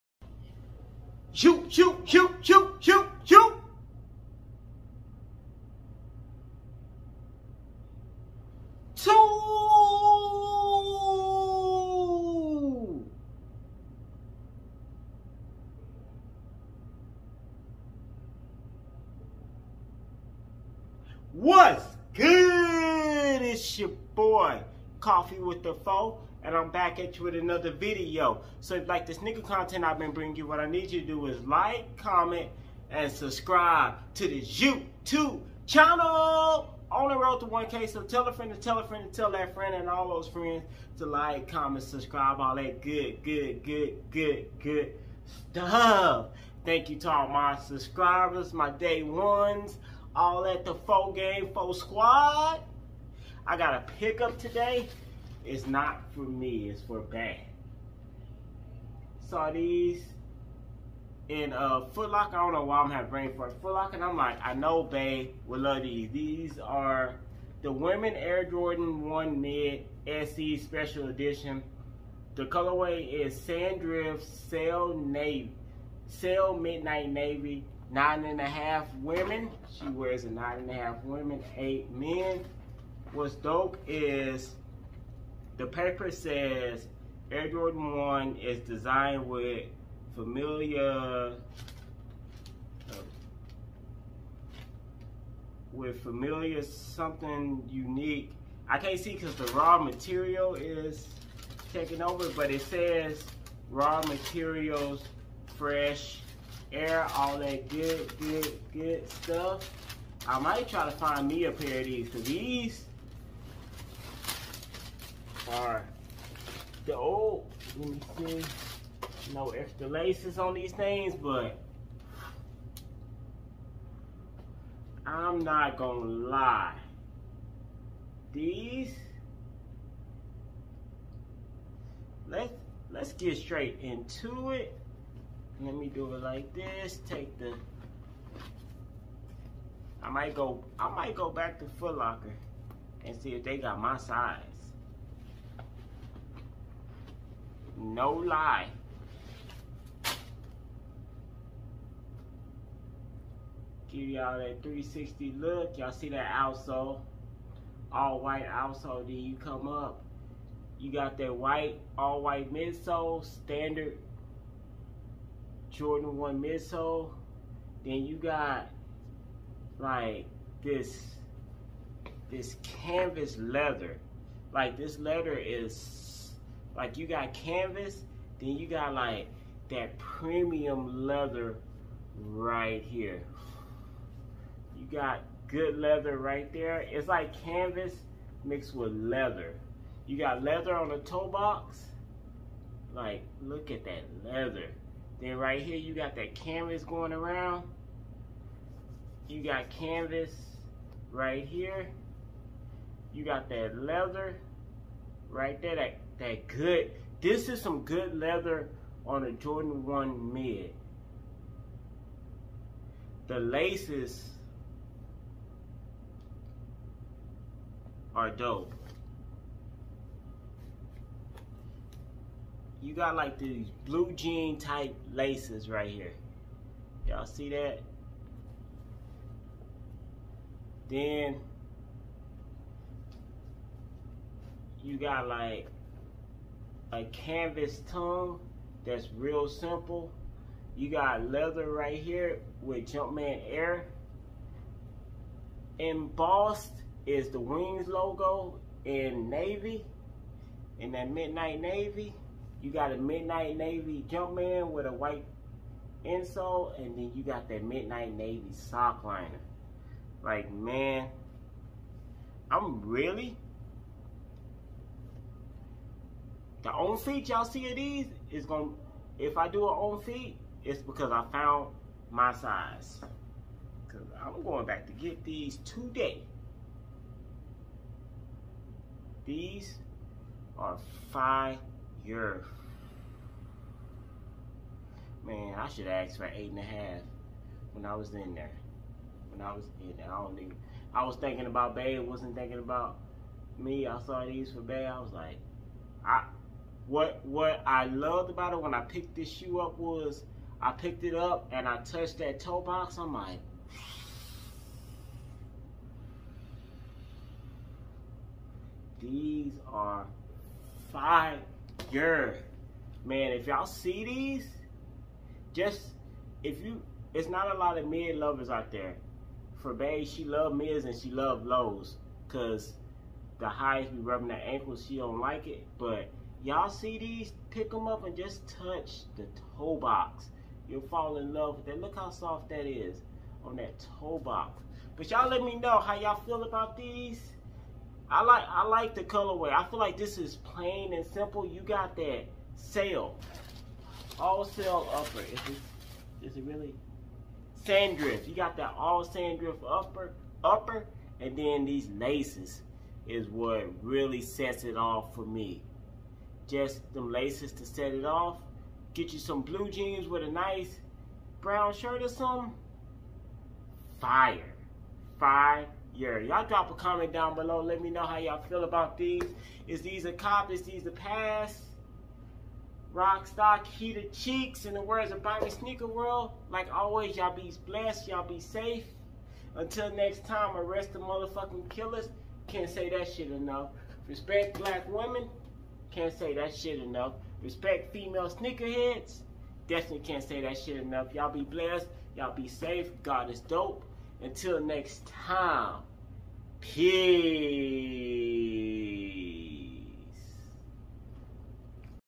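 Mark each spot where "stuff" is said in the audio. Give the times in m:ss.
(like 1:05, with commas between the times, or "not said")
0:45, 1:49.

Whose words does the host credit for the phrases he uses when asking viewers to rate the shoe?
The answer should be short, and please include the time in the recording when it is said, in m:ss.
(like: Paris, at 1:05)
Bobby Sneaker World, at 6:15.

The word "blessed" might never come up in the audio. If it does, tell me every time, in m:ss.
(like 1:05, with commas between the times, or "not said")
6:17, 6:31.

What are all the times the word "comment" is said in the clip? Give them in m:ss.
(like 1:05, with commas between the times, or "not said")
0:31, 0:41, 6:06.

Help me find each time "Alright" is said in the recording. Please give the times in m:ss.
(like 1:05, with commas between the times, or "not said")
1:55.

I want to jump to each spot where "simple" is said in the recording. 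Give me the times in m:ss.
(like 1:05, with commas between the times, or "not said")
3:59, 5:41.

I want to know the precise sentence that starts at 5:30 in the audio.
You'll fall in love with that.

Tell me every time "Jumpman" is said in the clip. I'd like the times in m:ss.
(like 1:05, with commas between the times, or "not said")
4:02, 4:14.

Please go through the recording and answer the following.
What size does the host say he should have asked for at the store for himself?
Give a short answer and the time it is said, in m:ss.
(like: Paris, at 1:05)
8.5, at 4:46.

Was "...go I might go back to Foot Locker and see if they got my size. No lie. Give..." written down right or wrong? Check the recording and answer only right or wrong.
right.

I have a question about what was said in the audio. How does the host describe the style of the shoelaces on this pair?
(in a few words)
blue jean type laces.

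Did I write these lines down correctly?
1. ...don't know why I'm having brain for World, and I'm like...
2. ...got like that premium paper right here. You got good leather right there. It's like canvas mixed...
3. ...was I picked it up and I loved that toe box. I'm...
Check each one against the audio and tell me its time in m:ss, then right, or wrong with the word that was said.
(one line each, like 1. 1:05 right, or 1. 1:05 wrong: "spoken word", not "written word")
1. 1:02 wrong: "Locker", not "World"
2. 2:58 wrong: "leather", not "paper"
3. 4:59 wrong: "touched", not "loved".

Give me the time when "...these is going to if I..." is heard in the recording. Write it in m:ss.
4:27.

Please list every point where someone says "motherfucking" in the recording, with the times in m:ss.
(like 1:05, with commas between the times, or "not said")
6:20.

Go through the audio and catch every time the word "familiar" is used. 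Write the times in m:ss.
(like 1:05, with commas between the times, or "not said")
1:30, 1:36.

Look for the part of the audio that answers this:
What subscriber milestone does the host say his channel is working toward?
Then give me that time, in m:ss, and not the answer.
0:37.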